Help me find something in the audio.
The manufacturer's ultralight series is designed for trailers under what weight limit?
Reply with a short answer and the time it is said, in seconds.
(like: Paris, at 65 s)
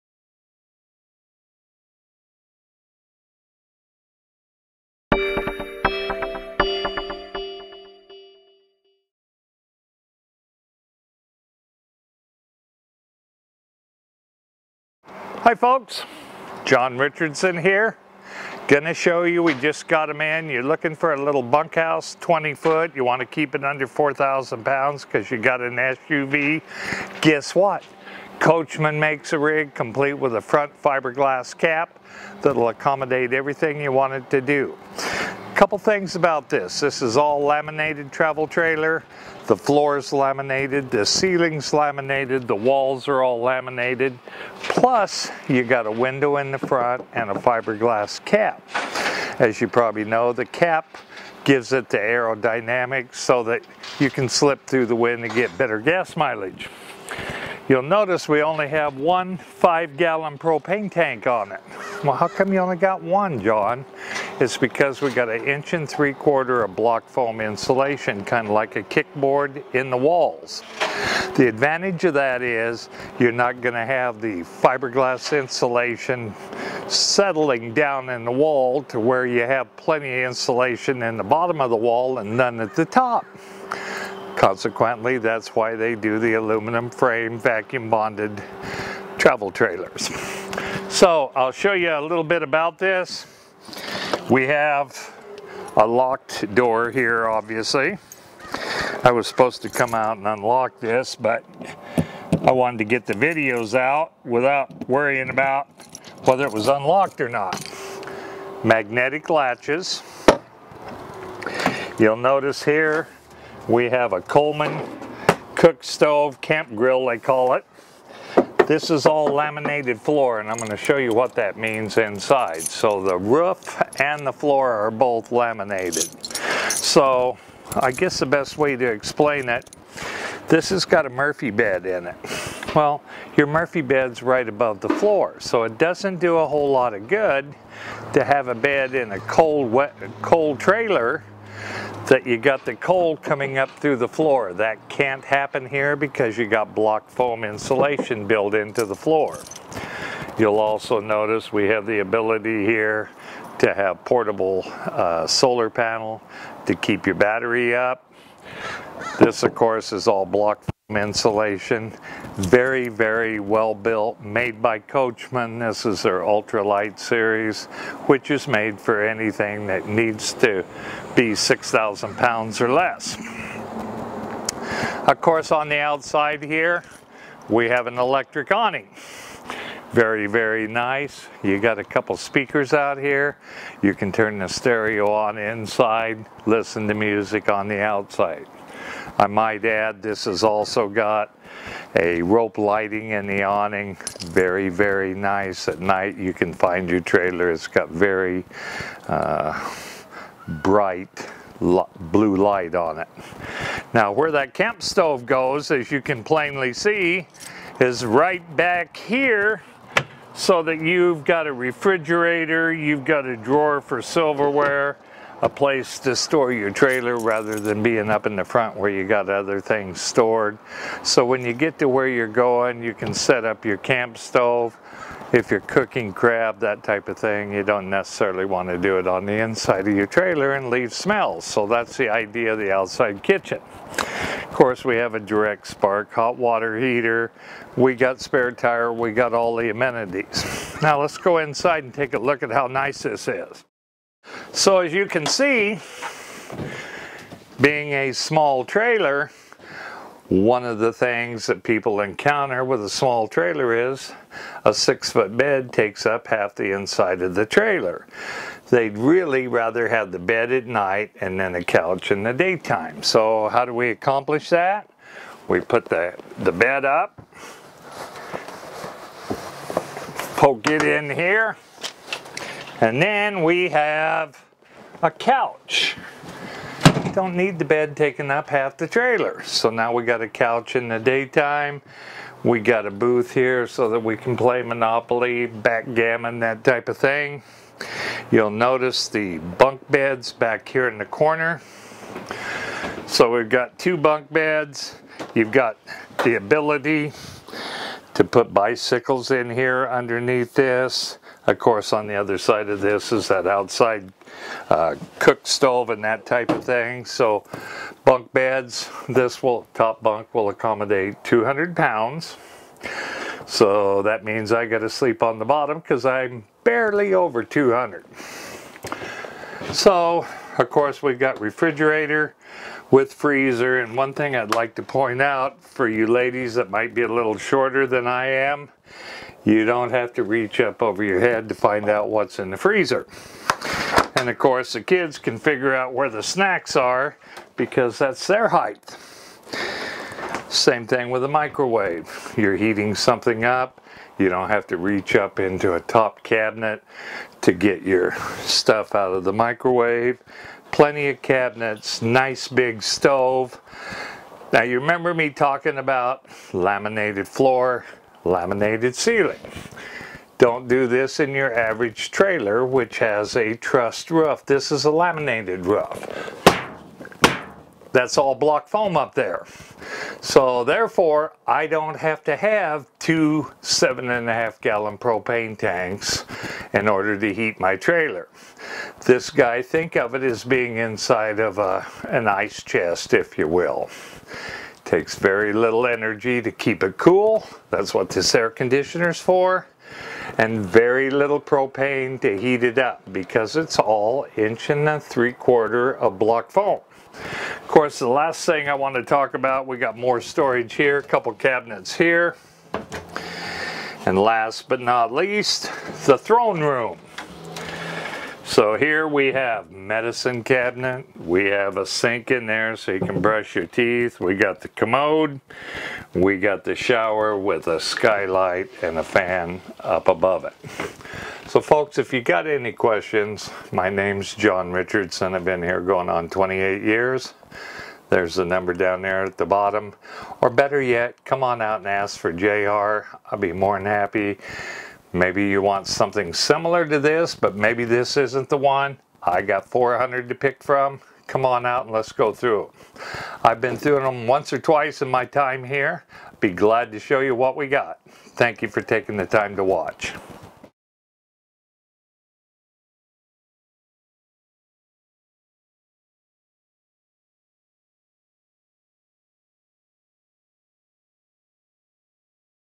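6,000 pounds, at 171 s.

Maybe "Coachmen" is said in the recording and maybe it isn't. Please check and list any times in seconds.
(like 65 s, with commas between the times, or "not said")
28 s, 164 s.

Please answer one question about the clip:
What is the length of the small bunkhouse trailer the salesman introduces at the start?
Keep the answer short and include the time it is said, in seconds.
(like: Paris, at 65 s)
20 foot, at 22 s.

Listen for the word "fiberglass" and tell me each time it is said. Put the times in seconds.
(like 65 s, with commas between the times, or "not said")
30 s, 47 s, 74 s.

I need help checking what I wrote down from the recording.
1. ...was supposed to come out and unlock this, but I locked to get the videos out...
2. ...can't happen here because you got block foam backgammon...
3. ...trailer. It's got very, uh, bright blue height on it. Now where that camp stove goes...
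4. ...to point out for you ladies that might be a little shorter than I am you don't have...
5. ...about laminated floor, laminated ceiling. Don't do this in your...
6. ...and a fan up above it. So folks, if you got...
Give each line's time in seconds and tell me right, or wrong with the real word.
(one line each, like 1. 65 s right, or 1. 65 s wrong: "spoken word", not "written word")
1. 99 s wrong: "wanted", not "locked"
2. 144 s wrong: "insulation", not "backgammon"
3. 197 s wrong: "light", not "height"
4. 324 s right
5. 355 s right
6. 418 s right.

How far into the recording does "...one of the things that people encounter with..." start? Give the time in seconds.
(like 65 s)
250 s.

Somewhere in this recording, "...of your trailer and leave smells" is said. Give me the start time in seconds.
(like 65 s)
229 s.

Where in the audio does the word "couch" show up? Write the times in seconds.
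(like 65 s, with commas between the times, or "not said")
261 s, 275 s, 280 s.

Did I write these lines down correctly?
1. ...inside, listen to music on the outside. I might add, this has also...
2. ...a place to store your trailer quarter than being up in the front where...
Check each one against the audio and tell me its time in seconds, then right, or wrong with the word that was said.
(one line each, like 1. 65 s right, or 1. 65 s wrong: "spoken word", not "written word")
1. 185 s right
2. 215 s wrong: "rather", not "quarter".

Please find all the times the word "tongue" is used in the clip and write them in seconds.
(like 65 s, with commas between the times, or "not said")
not said.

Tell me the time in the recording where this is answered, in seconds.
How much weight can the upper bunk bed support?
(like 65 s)
311 s.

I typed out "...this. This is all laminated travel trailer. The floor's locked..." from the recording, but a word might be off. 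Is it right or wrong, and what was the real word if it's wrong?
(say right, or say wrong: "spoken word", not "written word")
wrong: "laminated", not "locked".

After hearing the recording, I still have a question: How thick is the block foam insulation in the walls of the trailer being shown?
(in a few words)
1 3/4 inch.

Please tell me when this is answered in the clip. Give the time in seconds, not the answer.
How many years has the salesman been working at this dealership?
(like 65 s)
426 s.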